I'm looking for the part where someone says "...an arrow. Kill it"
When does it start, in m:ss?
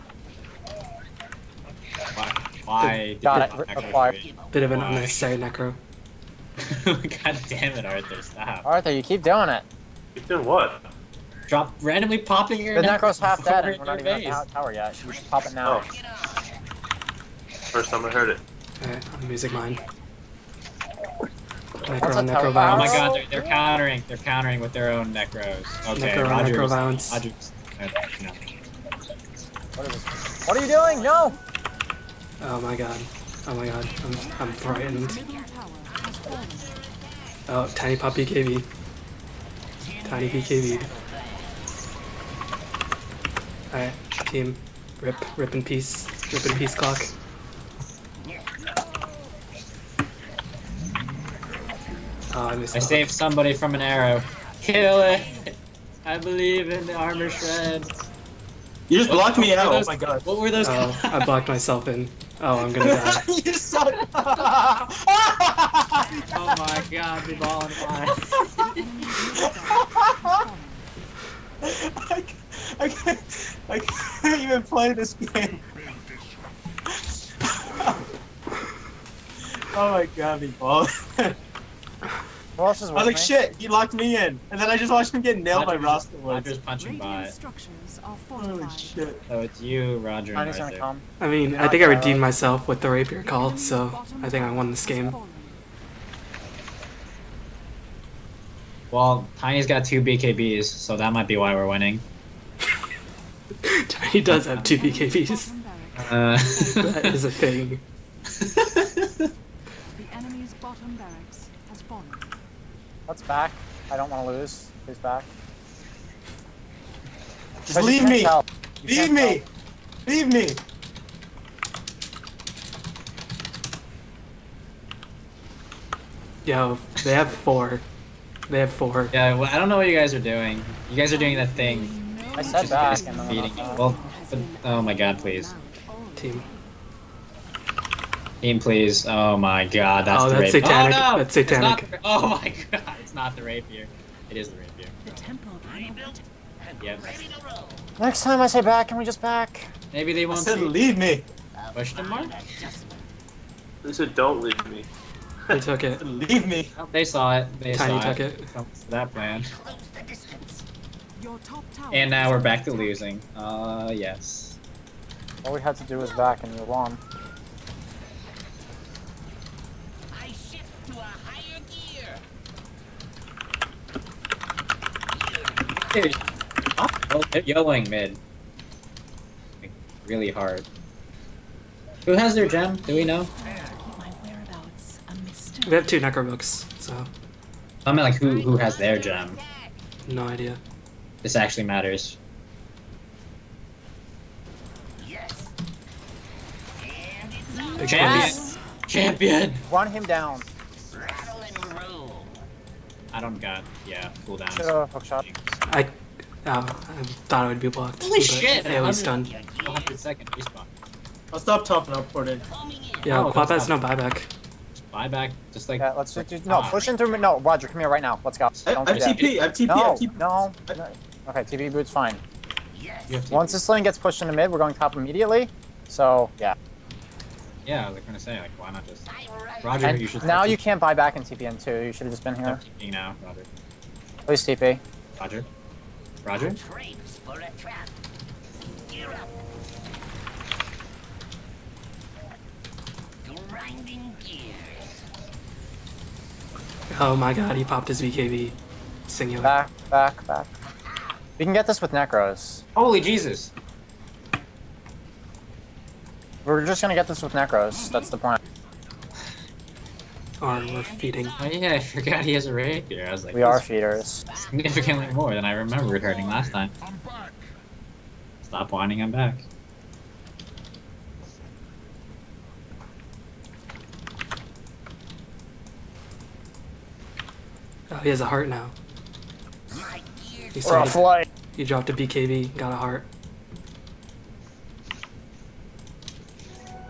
0:53.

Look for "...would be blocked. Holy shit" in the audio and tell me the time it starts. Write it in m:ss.
3:27.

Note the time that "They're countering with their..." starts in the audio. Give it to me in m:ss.
0:24.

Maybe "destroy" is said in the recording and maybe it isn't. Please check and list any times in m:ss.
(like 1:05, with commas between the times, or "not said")
not said.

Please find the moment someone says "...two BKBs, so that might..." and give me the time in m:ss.
1:39.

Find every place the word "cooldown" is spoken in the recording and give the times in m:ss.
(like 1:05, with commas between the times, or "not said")
3:24.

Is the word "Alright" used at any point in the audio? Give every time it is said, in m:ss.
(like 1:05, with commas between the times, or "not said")
0:18, 0:43.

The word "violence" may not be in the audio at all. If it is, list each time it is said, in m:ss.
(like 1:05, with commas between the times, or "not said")
0:22, 0:26.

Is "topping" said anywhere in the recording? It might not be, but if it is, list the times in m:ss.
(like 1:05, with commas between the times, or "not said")
3:31.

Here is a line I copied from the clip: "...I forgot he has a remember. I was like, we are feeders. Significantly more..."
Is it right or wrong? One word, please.
wrong.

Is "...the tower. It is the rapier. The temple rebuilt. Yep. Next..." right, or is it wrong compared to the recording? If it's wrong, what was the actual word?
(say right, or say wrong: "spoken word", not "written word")
wrong: "rapier", not "tower".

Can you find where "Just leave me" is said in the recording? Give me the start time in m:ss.
1:57.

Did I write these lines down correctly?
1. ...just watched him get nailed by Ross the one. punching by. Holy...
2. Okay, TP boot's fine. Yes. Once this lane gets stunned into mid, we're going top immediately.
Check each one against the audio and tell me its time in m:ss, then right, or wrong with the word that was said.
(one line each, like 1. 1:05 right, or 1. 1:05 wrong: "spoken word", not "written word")
1. 1:24 right
2. 3:41 wrong: "pushed", not "stunned".